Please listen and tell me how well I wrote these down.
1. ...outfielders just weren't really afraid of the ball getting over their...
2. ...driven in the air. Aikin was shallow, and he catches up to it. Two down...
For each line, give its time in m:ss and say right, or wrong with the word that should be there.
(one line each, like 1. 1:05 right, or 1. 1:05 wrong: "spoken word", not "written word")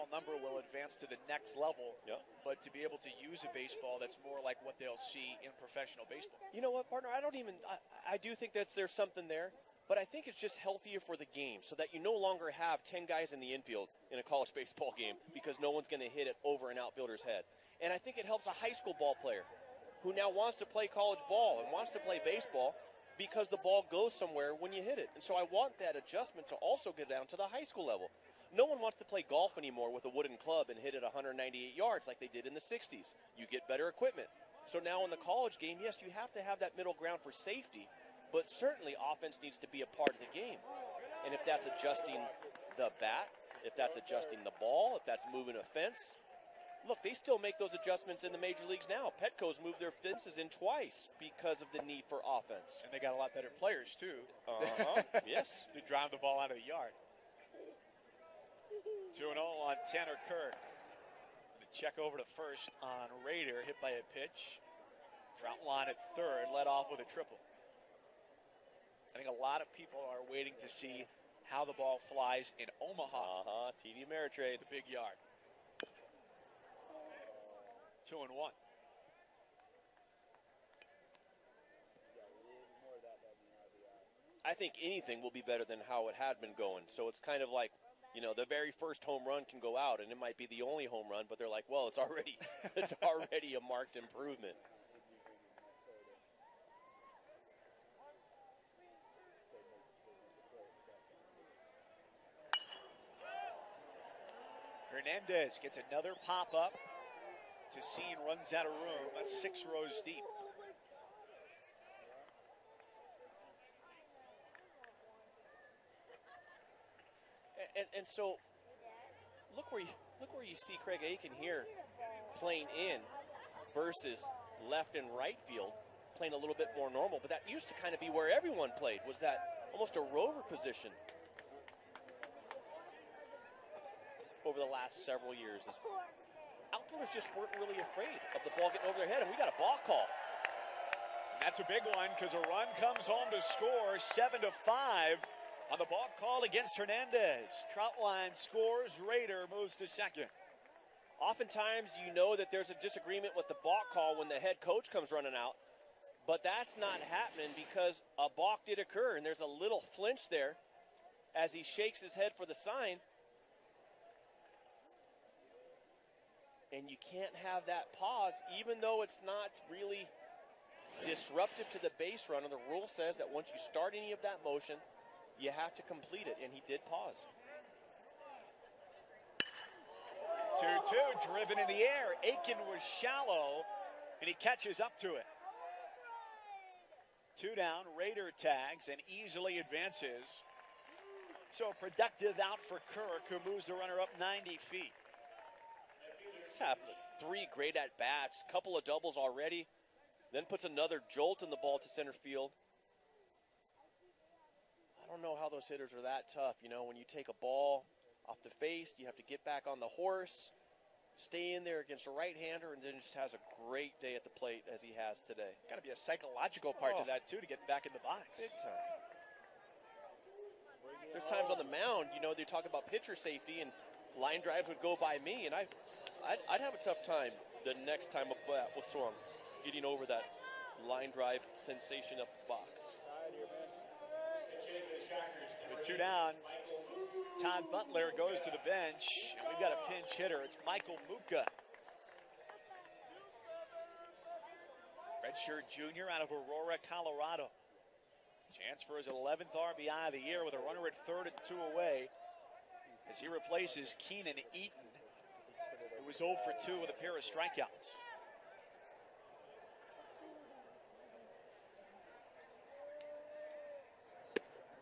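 1. 2:16 right
2. 3:01 right.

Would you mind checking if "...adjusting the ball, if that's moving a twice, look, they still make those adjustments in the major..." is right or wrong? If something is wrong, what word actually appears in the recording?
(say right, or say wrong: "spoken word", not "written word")
wrong: "fence", not "twice".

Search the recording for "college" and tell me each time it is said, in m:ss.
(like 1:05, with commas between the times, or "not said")
0:14, 0:20, 0:35.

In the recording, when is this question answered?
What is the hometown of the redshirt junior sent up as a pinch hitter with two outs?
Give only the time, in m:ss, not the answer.
4:06.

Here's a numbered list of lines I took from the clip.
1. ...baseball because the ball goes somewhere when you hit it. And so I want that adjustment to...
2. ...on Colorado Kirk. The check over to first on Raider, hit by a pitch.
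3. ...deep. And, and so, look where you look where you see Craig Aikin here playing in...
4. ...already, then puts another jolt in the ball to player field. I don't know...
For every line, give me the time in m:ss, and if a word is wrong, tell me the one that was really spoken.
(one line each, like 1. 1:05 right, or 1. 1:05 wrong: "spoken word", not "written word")
1. 0:22 right
2. 0:59 wrong: "Tanner", not "Colorado"
3. 1:50 right
4. 3:19 wrong: "center", not "player".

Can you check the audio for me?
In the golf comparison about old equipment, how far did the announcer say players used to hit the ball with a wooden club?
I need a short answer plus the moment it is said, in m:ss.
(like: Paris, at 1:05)
198 yards, at 0:31.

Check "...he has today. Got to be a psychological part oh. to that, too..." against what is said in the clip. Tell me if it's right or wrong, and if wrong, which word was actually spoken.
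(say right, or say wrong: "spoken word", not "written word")
right.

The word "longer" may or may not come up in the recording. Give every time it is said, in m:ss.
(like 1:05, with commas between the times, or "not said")
0:12.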